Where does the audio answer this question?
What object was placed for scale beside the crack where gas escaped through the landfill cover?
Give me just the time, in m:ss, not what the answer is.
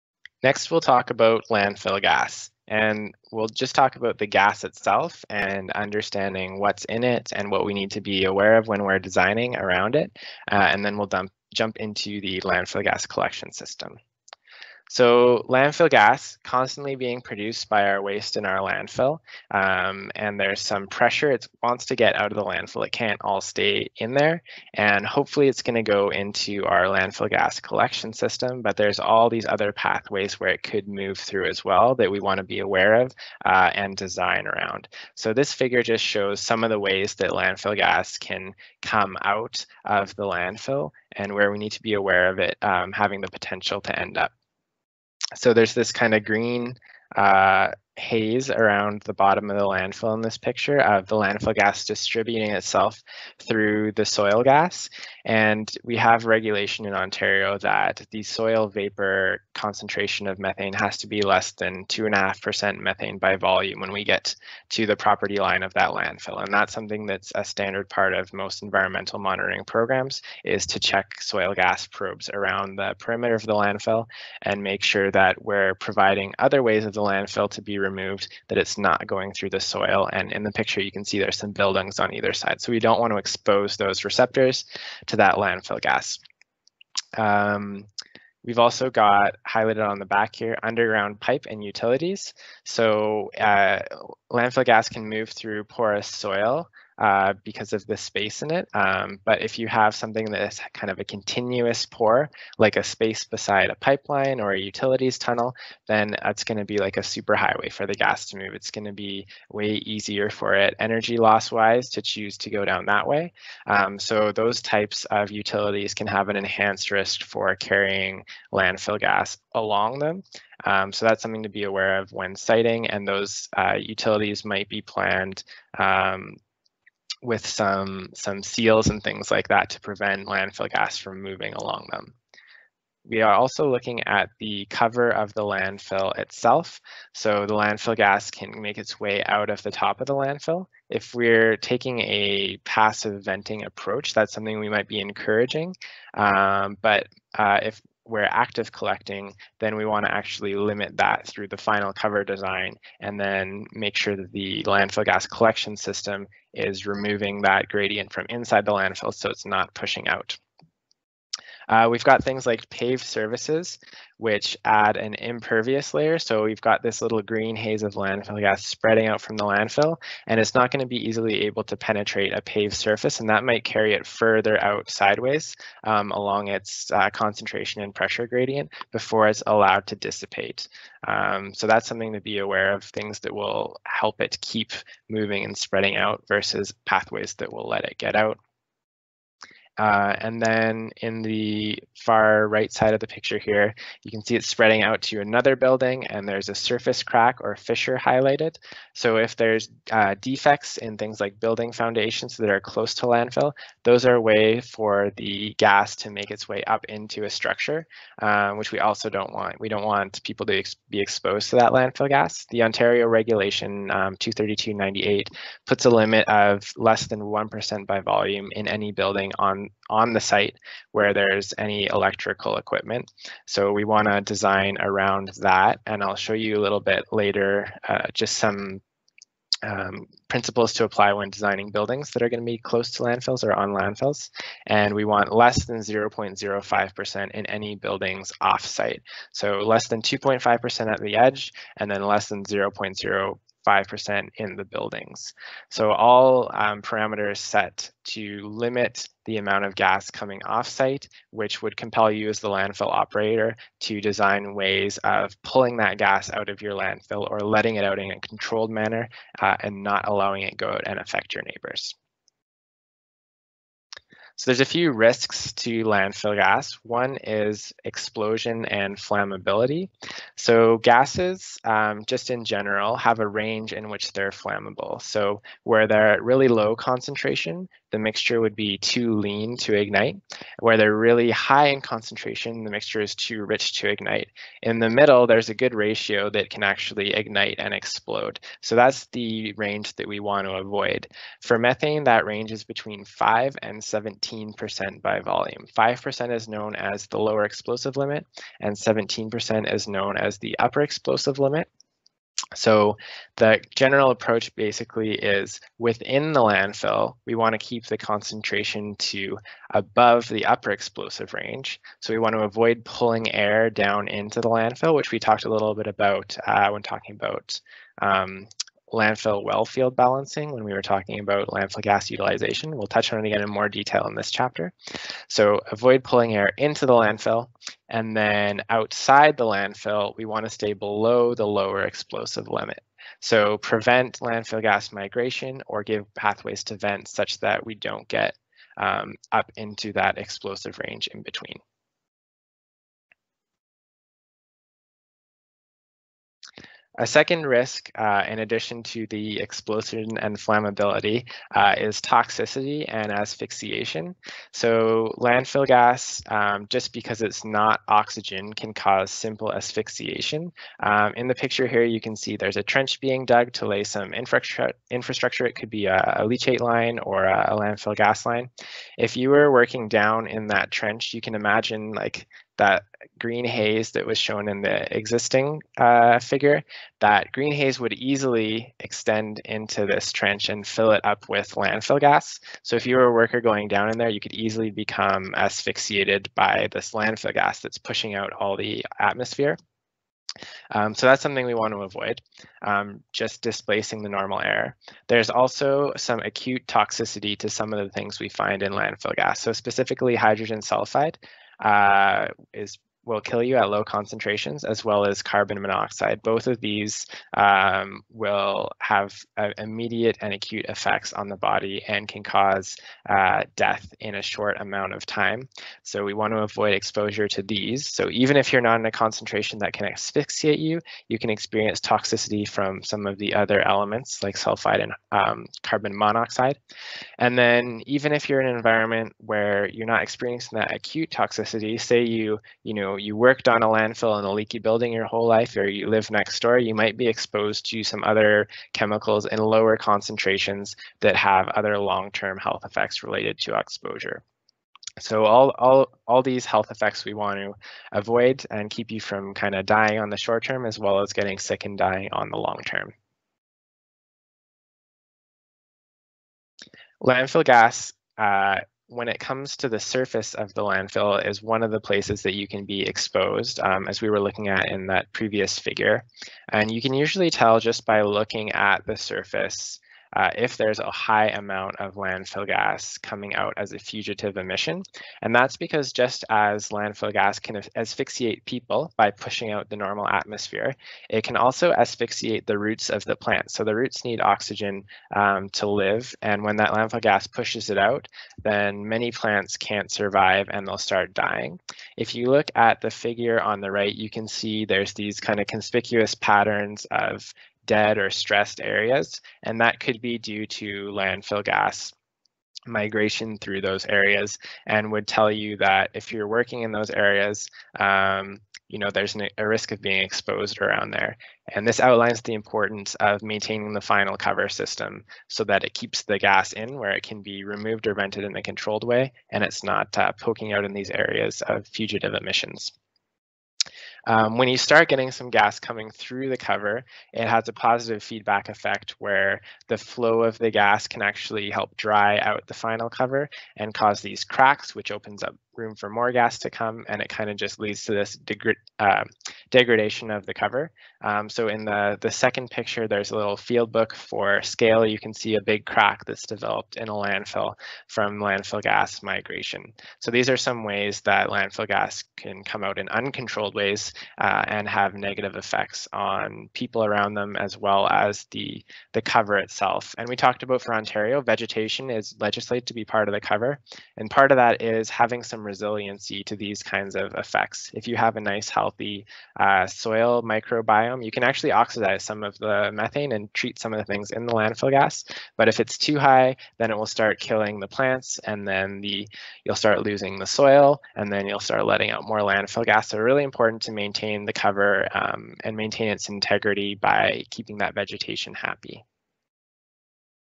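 9:03.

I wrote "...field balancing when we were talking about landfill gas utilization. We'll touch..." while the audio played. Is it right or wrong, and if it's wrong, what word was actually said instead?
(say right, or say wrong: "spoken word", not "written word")
right.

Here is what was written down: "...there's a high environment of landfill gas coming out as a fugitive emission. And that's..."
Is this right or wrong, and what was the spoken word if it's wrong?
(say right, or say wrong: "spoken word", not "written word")
wrong: "amount", not "environment".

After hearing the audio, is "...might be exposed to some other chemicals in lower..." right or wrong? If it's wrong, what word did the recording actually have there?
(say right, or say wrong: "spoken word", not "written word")
right.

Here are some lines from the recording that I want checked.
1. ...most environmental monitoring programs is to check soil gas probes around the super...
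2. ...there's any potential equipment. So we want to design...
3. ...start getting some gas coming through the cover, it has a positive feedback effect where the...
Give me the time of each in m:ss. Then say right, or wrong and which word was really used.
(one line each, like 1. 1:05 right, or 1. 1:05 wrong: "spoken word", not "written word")
1. 1:08 wrong: "perimeter", not "super"
2. 3:41 wrong: "electrical", not "potential"
3. 8:44 right.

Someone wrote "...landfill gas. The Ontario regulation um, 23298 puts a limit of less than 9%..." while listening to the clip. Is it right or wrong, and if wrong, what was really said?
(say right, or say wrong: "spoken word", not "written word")
wrong: "1", not "9".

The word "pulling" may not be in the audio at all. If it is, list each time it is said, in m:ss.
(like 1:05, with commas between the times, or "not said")
4:15, 5:12, 5:26.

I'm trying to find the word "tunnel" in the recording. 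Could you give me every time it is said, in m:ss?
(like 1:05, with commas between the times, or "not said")
1:45.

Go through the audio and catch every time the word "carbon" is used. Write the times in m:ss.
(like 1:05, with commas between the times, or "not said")
6:45, 7:05.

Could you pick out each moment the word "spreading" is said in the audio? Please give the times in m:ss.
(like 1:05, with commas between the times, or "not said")
2:48, 3:05, 3:14.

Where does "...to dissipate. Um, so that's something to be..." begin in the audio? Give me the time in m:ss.
2:59.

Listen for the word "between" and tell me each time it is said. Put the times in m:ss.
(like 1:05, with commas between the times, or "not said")
4:52, 5:41.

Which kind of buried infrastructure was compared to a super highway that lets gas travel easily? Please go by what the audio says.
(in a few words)
pipe and utilities.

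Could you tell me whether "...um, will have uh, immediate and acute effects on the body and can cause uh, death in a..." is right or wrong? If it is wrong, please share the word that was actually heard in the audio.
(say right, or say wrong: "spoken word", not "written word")
right.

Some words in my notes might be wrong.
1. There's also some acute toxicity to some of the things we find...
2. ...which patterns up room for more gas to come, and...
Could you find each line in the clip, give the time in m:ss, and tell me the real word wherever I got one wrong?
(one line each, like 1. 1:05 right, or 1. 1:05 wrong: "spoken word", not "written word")
1. 6:35 right
2. 8:54 wrong: "opens", not "patterns".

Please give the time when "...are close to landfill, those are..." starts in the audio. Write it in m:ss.
3:22.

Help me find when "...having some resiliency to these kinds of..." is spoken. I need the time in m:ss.
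9:24.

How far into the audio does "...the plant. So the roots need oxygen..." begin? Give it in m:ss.
8:03.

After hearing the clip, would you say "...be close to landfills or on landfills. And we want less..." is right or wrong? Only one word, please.
right.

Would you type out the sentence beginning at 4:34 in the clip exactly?
So where they're at really low concentration, the mixture would be too lean to ignite.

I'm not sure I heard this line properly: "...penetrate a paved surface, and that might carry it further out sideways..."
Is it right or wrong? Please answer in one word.
right.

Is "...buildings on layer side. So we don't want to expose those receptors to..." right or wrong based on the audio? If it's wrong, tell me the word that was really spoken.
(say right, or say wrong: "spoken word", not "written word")
wrong: "either", not "layer".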